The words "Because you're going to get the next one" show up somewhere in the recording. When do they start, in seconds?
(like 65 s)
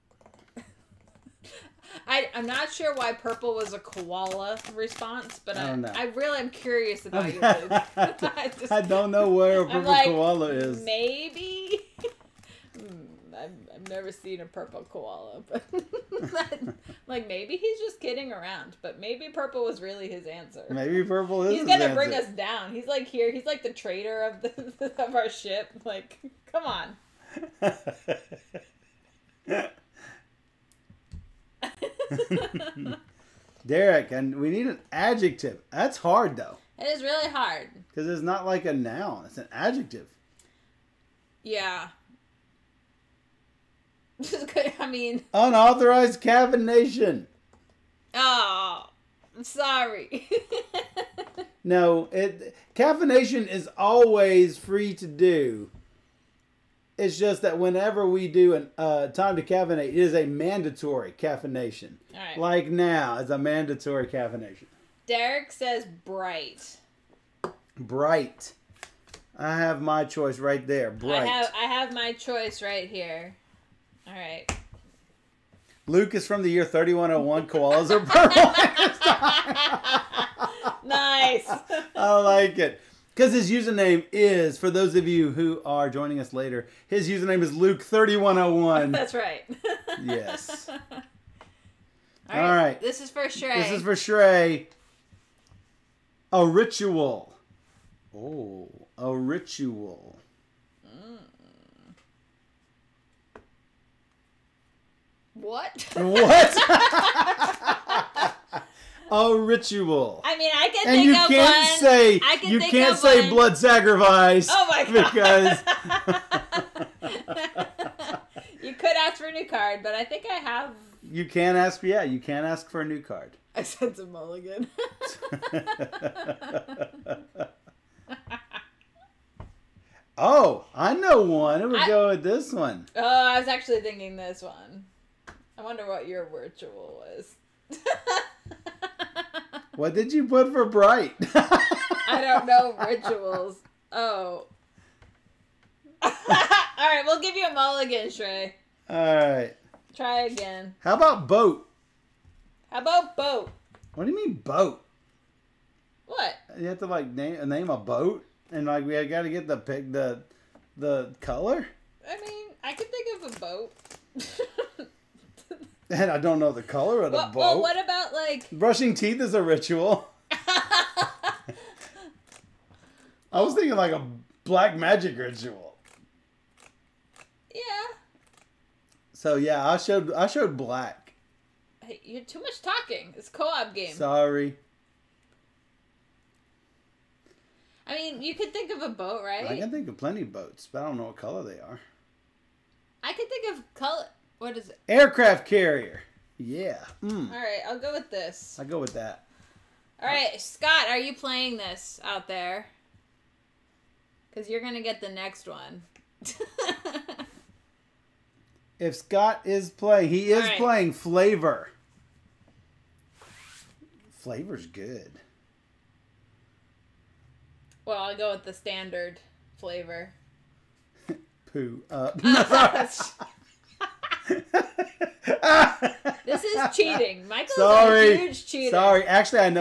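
204 s.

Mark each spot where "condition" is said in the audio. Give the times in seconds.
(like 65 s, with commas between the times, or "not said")
not said.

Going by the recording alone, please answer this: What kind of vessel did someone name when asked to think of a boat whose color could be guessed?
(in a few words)
Aircraft carrier.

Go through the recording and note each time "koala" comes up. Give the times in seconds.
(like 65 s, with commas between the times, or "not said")
3 s, 10 s, 14 s, 77 s.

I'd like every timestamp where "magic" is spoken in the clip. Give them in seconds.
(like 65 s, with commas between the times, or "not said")
174 s.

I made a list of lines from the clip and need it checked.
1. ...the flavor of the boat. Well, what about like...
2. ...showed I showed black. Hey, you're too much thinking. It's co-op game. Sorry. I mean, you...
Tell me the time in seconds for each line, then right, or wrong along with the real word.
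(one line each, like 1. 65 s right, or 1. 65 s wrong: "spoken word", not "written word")
1. 166 s wrong: "color", not "flavor"
2. 179 s wrong: "talking", not "thinking".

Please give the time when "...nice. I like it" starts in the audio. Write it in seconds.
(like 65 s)
80 s.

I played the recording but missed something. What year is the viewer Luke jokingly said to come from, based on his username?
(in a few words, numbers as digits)
3101.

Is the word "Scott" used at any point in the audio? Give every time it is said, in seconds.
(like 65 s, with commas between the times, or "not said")
200 s, 208 s.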